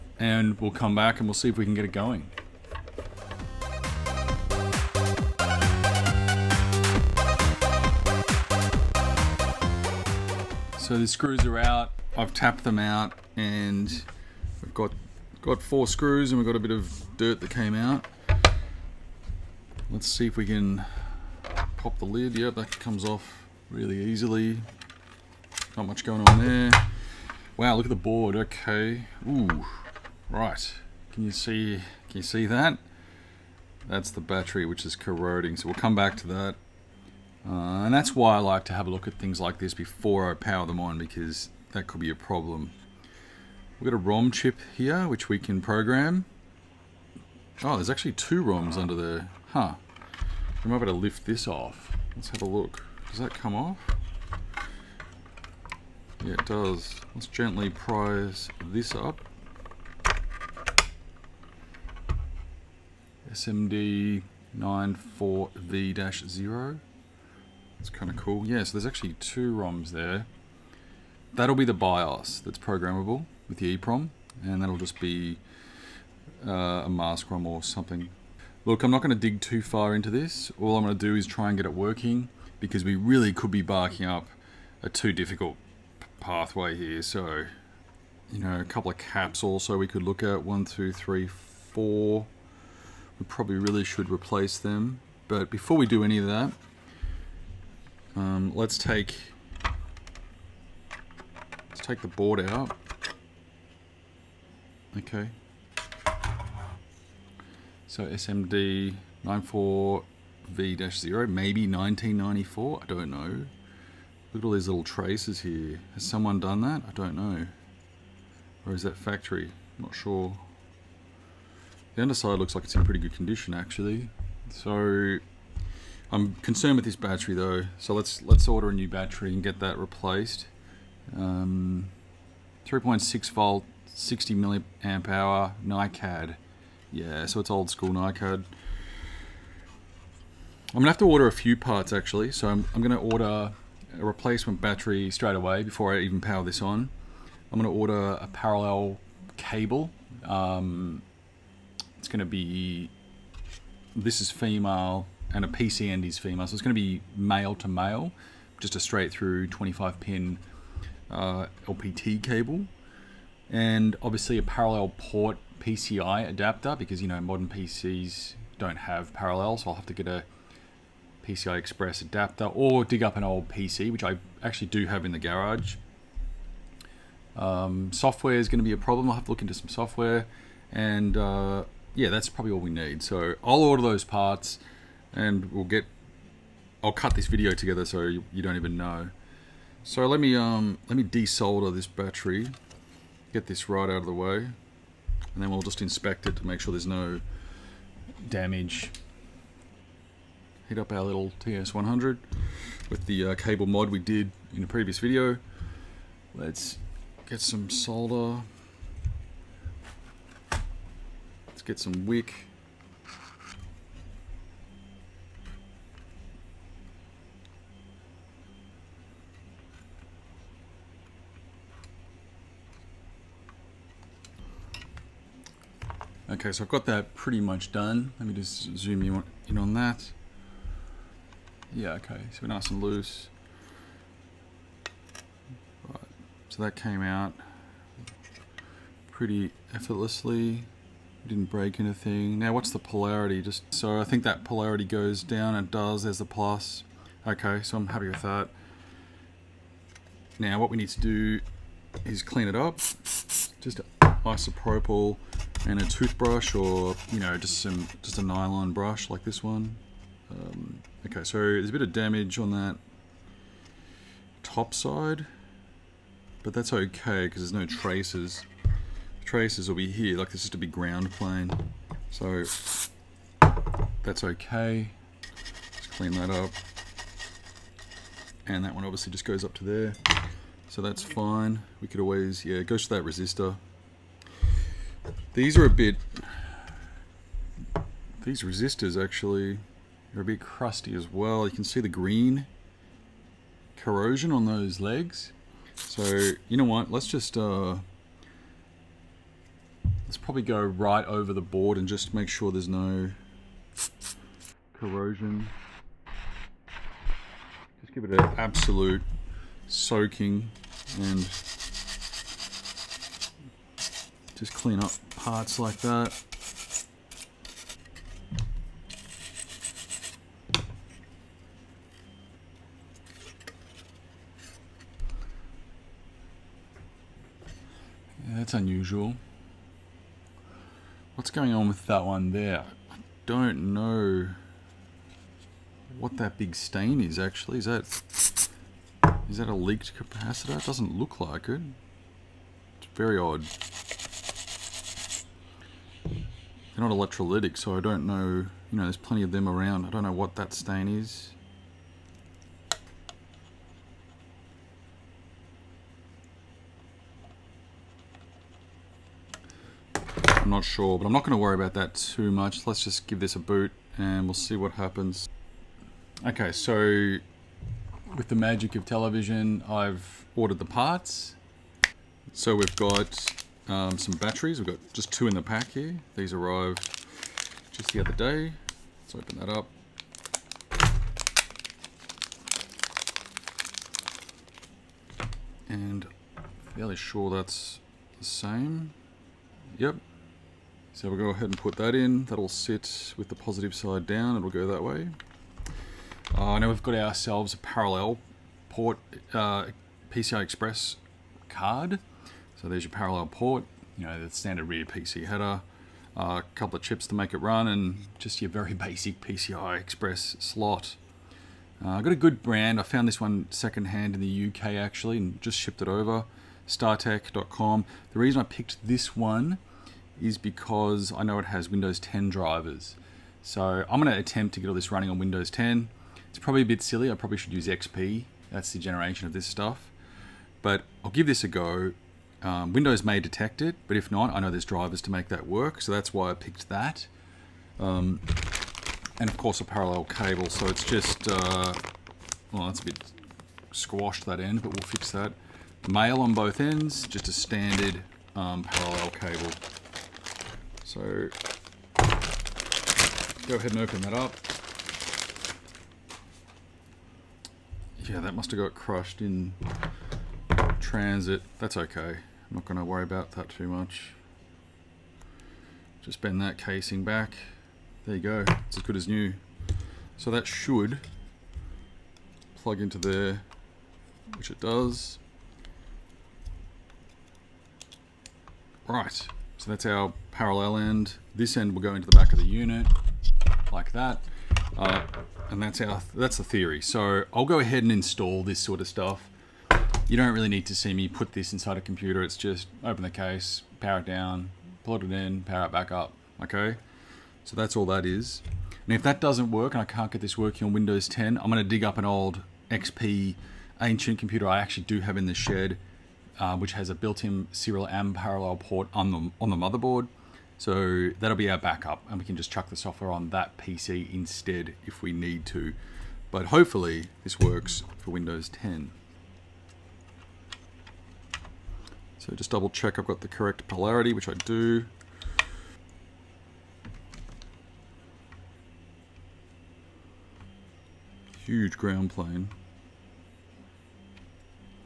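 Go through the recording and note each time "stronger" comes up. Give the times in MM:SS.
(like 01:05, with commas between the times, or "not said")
not said.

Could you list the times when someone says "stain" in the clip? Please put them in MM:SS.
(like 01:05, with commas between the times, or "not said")
05:36, 05:50.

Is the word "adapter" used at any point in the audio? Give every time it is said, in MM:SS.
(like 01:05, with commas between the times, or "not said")
02:46, 02:52.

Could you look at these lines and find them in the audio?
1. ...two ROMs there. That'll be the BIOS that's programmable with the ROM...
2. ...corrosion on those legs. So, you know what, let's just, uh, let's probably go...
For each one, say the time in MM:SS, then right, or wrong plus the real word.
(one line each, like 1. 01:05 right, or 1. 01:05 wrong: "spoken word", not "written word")
1. 01:09 wrong: "EEPROM", not "ROM"
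2. 04:53 right.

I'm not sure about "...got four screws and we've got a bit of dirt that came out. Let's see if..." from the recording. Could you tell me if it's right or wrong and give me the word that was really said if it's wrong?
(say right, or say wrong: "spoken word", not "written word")
right.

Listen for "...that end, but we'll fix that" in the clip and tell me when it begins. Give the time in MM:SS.
07:24.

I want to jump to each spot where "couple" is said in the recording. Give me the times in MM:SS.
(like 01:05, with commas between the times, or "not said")
01:28, 06:46.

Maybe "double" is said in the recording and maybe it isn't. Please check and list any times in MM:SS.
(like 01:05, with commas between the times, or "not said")
08:42.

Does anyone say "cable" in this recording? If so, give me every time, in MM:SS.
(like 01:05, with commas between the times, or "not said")
02:29, 02:42, 03:23, 07:20, 07:29.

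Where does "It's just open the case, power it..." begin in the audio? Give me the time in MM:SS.
08:12.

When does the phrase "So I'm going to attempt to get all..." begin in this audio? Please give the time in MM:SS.
07:03.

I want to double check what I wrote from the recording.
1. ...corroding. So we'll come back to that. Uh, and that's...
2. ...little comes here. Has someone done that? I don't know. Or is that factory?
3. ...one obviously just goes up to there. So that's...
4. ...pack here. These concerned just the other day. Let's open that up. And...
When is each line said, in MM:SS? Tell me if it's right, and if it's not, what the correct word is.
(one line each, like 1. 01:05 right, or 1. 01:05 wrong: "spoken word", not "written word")
1. 00:34 right
2. 01:54 wrong: "traces", not "comes"
3. 04:38 right
4. 06:15 wrong: "arrived", not "concerned".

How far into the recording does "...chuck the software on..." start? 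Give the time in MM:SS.
08:32.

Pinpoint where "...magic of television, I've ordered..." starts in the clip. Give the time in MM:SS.
06:08.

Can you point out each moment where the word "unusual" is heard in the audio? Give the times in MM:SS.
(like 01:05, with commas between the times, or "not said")
05:28.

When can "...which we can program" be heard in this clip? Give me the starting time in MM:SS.
00:45.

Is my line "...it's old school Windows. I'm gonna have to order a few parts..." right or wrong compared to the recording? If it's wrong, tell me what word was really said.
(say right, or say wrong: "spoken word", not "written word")
wrong: "NiCad", not "Windows".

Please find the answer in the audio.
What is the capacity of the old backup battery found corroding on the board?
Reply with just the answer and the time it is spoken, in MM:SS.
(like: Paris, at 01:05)
60 milliamp hour, at 02:13.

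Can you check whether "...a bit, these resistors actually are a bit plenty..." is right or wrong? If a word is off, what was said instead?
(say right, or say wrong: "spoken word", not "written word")
wrong: "crusty", not "plenty".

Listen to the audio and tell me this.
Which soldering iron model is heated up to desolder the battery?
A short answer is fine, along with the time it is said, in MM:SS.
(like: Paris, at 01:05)
TS100, at 03:21.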